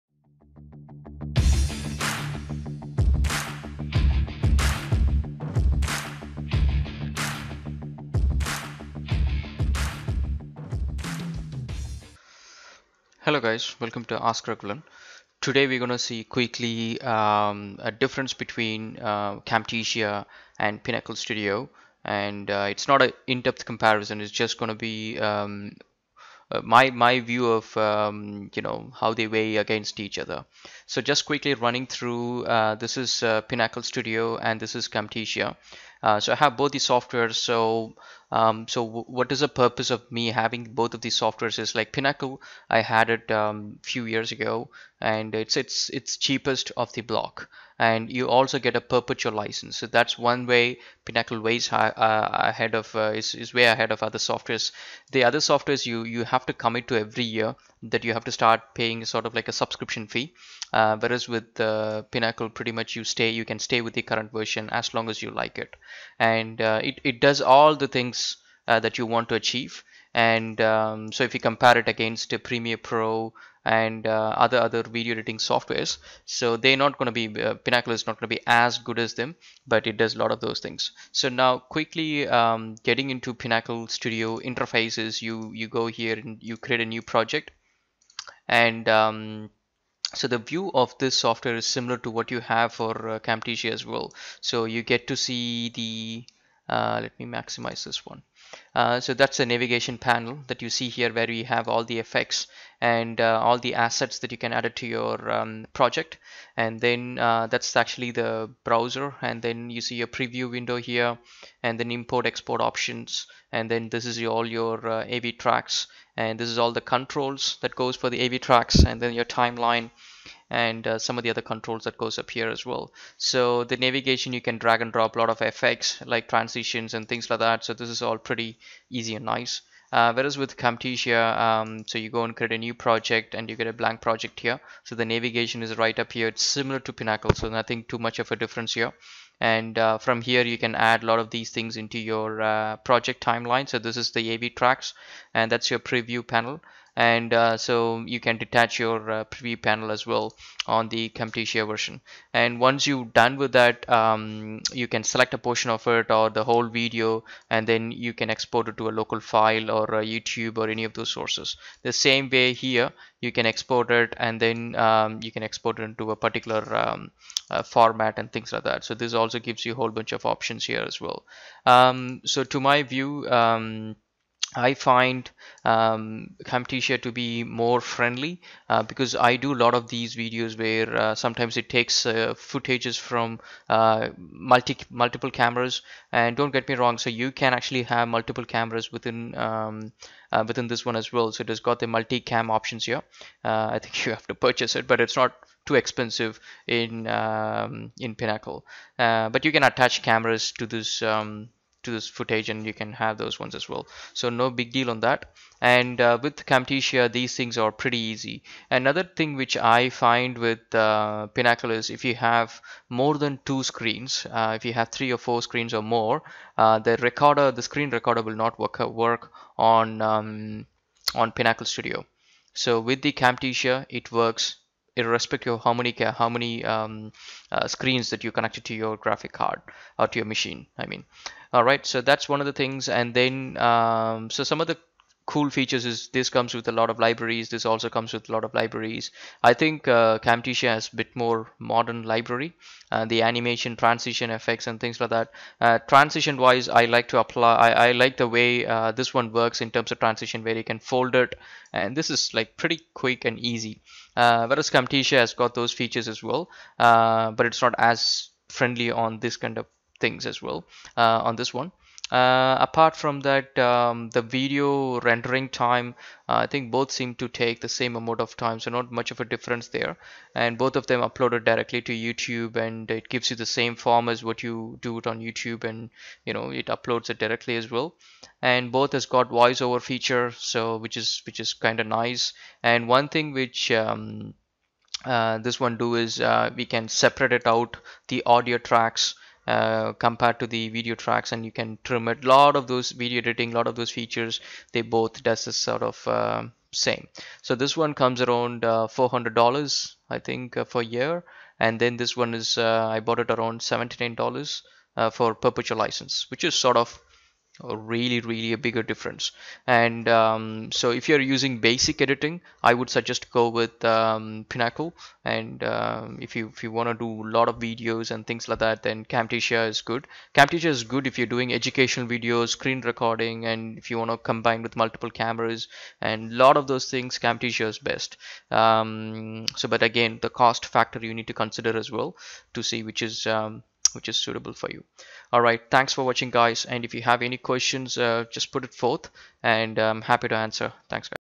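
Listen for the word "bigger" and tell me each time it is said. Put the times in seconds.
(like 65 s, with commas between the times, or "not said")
308 s.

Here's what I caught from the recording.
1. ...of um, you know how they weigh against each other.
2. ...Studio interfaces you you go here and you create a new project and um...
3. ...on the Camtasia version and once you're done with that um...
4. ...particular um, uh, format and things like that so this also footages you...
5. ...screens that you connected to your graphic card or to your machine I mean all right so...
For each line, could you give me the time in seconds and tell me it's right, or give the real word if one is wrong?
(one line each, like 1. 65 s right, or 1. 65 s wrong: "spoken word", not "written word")
1. 27 s right
2. 83 s right
3. 150 s right
4. 166 s wrong: "gives", not "footages"
5. 227 s right.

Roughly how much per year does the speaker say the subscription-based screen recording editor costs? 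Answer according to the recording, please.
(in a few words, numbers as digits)
$400.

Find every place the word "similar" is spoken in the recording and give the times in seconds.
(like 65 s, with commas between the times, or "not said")
91 s, 136 s.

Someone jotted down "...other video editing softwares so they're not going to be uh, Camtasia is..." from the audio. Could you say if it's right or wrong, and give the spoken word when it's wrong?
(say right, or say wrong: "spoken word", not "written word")
wrong: "Pinnacle", not "Camtasia".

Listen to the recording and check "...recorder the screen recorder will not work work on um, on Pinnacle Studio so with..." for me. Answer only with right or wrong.
right.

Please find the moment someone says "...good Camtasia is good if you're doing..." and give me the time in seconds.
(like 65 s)
319 s.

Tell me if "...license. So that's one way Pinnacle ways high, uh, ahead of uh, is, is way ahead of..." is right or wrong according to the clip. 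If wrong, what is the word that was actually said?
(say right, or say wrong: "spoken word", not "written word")
right.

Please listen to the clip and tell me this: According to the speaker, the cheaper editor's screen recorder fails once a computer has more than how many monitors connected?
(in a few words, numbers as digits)
2.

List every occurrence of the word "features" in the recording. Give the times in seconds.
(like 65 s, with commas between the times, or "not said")
235 s, 255 s, 279 s, 293 s.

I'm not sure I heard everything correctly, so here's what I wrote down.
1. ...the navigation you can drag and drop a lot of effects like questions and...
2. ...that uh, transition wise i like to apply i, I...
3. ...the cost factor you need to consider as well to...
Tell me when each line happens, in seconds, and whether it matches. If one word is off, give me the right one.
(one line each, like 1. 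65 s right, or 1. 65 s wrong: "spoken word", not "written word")
1. 123 s wrong: "transitions", not "questions"
2. 245 s right
3. 330 s right.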